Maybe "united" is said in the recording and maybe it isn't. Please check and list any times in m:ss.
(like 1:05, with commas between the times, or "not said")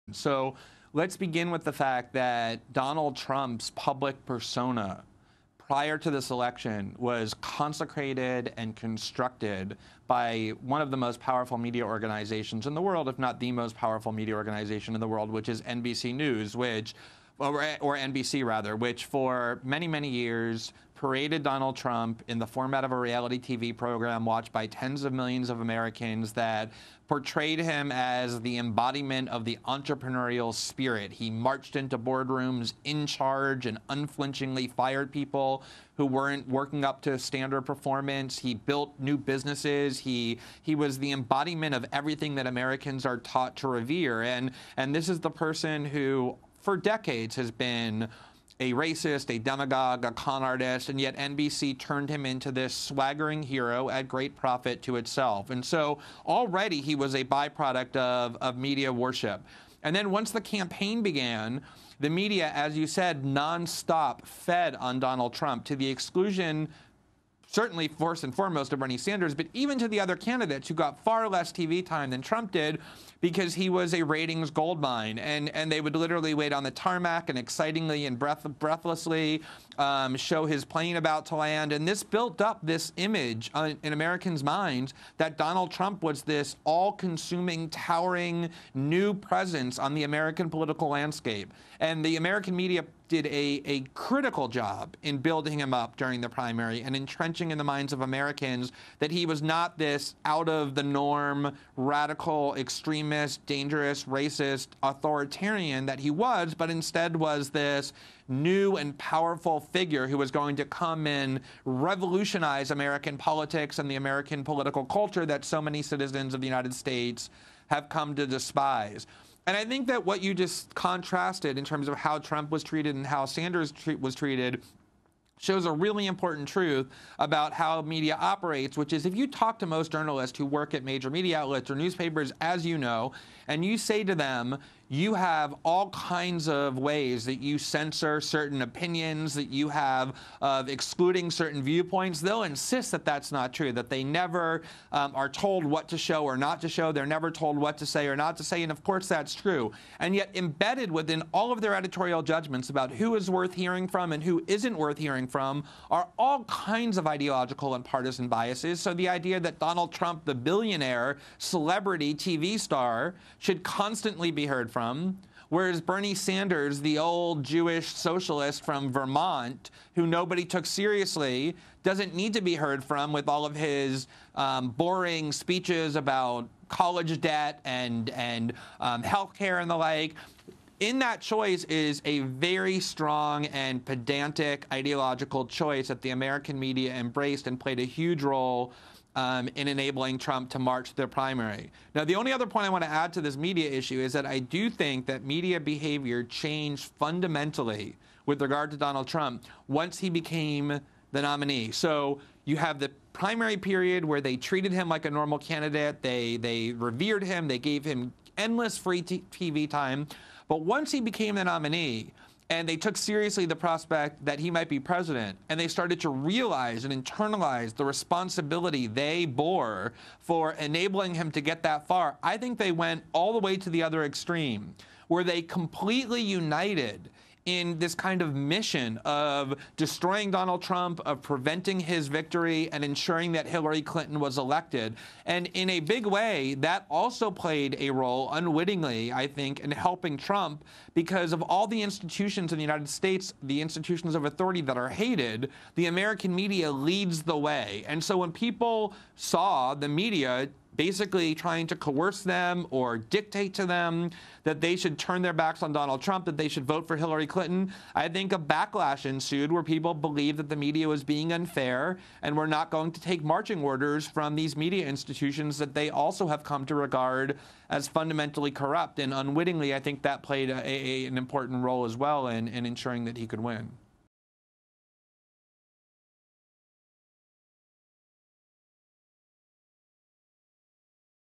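1:56, 3:46, 4:02.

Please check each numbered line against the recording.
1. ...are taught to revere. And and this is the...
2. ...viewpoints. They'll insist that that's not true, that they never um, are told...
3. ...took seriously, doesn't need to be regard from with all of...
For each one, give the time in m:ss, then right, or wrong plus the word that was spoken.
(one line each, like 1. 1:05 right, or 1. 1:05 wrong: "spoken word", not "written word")
1. 0:43 right
2. 2:21 right
3. 2:50 wrong: "heard", not "regard".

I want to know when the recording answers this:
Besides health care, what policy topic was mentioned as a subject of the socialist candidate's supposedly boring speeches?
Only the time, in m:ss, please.
2:56.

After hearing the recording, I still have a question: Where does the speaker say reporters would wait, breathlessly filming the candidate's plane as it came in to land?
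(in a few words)
the tarmac.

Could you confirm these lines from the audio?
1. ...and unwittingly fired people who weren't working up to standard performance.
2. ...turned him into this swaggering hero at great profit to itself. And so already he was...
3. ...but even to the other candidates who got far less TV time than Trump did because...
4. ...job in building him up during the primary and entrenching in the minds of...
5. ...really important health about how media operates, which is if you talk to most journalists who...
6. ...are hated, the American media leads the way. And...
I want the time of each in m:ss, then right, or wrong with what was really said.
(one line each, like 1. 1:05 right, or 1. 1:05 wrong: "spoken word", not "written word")
1. 0:33 wrong: "unflinchingly", not "unwittingly"
2. 0:51 right
3. 1:09 right
4. 1:34 right
5. 2:05 wrong: "truth", not "health"
6. 4:04 right.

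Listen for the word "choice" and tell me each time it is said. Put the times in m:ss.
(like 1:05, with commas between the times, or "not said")
3:01, 3:05.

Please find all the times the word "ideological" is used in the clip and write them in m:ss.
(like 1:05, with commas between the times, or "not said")
2:37, 3:04.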